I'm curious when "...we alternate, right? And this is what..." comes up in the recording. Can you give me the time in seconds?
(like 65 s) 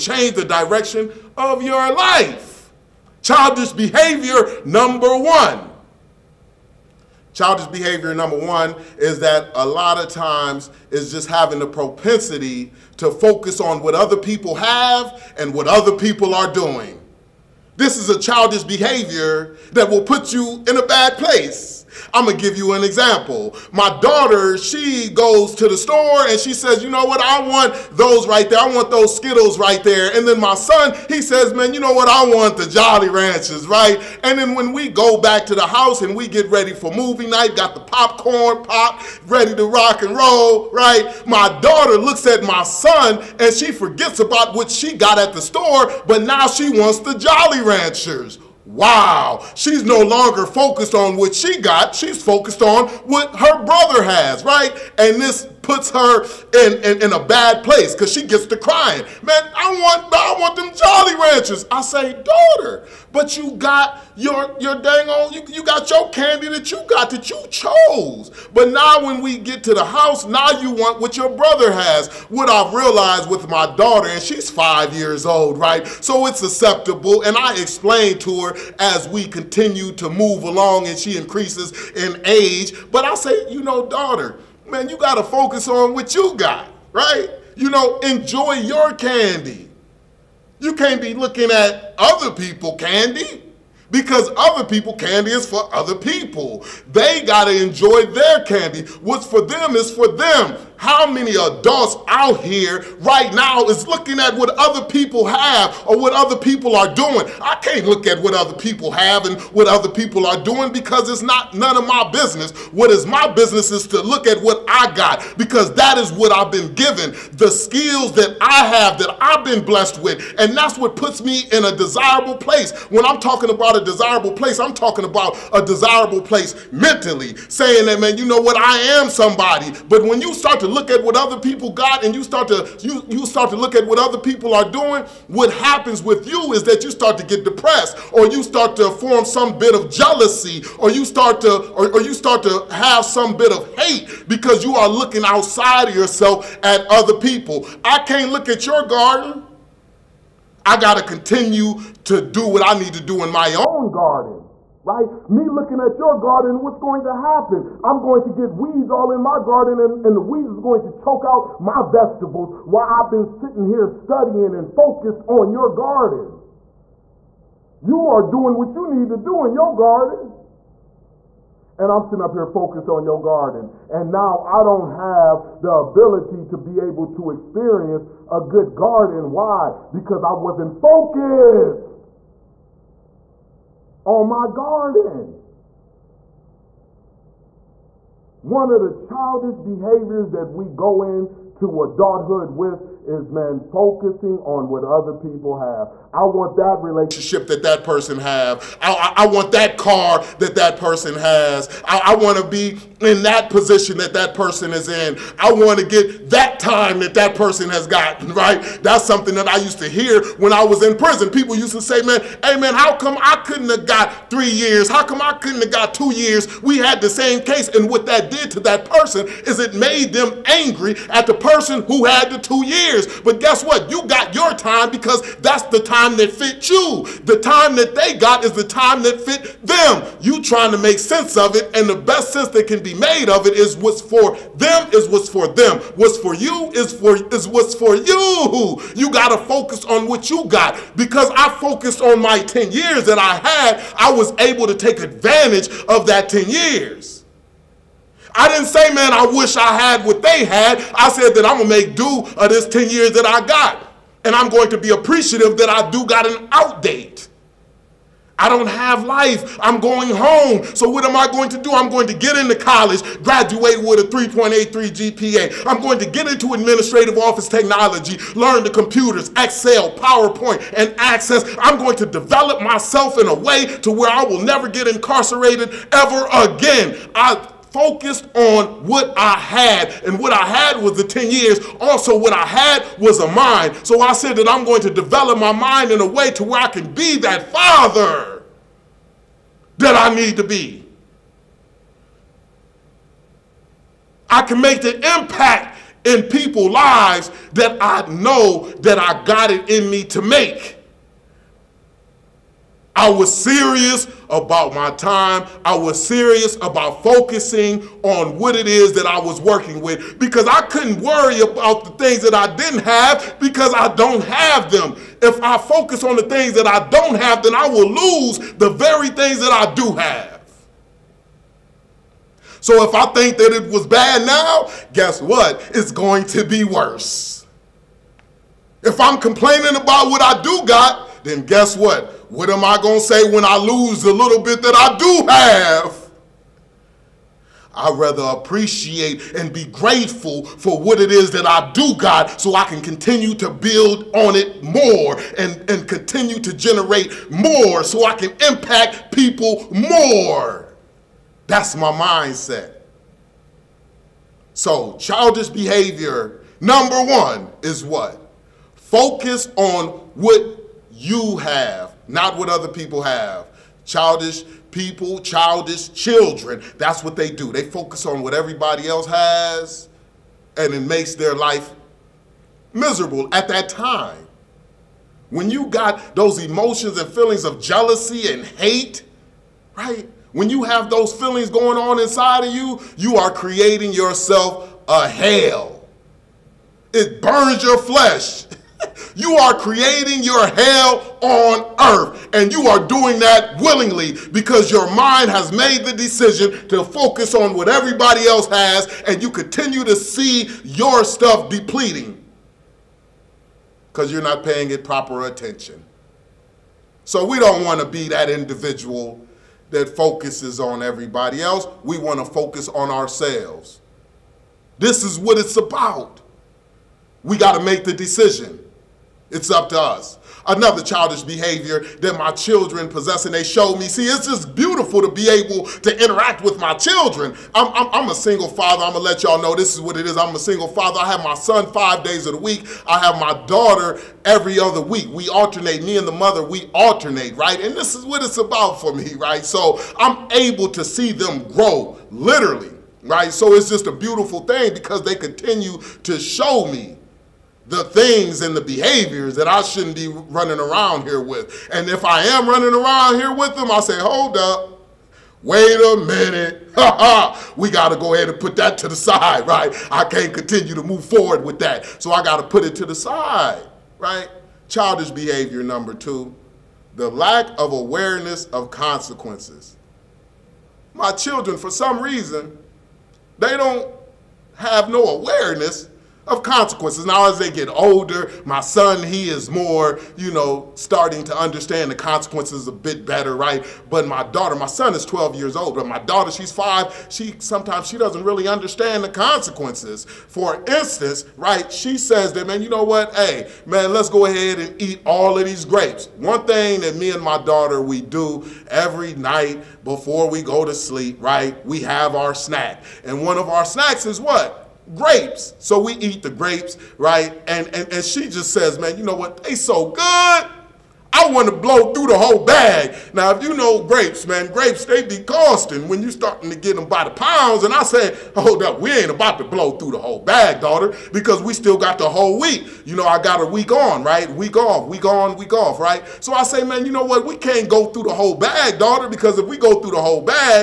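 436 s.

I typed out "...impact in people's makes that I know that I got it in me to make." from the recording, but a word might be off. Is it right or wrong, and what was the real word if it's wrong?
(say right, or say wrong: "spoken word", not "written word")
wrong: "lives", not "makes".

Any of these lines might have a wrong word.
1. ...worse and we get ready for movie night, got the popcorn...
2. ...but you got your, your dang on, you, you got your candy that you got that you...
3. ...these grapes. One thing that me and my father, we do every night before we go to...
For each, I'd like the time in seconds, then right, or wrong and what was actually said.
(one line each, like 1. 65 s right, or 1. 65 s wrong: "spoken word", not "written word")
1. 35 s wrong: "house", not "worse"
2. 63 s right
3. 495 s wrong: "daughter", not "father".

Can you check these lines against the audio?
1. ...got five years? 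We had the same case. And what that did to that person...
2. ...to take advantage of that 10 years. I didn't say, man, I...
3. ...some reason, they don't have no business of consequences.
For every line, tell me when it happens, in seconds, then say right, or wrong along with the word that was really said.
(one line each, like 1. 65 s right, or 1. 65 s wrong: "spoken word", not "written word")
1. 215 s wrong: "two", not "five"
2. 244 s right
3. 471 s wrong: "awareness", not "business".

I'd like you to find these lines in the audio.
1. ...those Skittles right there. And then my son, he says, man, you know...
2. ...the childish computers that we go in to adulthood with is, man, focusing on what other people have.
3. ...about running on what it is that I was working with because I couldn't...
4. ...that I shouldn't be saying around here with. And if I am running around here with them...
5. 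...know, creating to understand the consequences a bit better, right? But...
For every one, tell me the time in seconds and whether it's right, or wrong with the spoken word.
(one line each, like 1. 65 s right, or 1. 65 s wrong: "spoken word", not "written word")
1. 28 s right
2. 188 s wrong: "behaviors", not "computers"
3. 306 s wrong: "focusing", not "running"
4. 449 s wrong: "running", not "saying"
5. 480 s wrong: "starting", not "creating".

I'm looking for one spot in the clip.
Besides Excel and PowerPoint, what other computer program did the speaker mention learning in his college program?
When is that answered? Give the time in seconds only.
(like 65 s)
270 s.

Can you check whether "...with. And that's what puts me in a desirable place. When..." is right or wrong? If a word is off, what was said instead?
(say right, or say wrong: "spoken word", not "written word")
right.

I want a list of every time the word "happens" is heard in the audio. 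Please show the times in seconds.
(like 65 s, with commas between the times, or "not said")
135 s, 157 s.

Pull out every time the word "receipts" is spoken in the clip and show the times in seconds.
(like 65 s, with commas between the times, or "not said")
not said.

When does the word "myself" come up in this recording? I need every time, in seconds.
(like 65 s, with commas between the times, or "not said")
272 s.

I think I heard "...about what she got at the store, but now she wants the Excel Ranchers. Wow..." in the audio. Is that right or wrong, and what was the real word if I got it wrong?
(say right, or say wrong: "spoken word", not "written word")
wrong: "Jolly", not "Excel".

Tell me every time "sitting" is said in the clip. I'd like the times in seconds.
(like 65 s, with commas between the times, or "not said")
163 s, 172 s.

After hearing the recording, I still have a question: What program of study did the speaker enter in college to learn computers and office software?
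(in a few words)
Administrative office technology.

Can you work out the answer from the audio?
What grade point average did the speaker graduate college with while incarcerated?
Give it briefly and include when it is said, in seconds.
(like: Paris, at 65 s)
3.83, at 264 s.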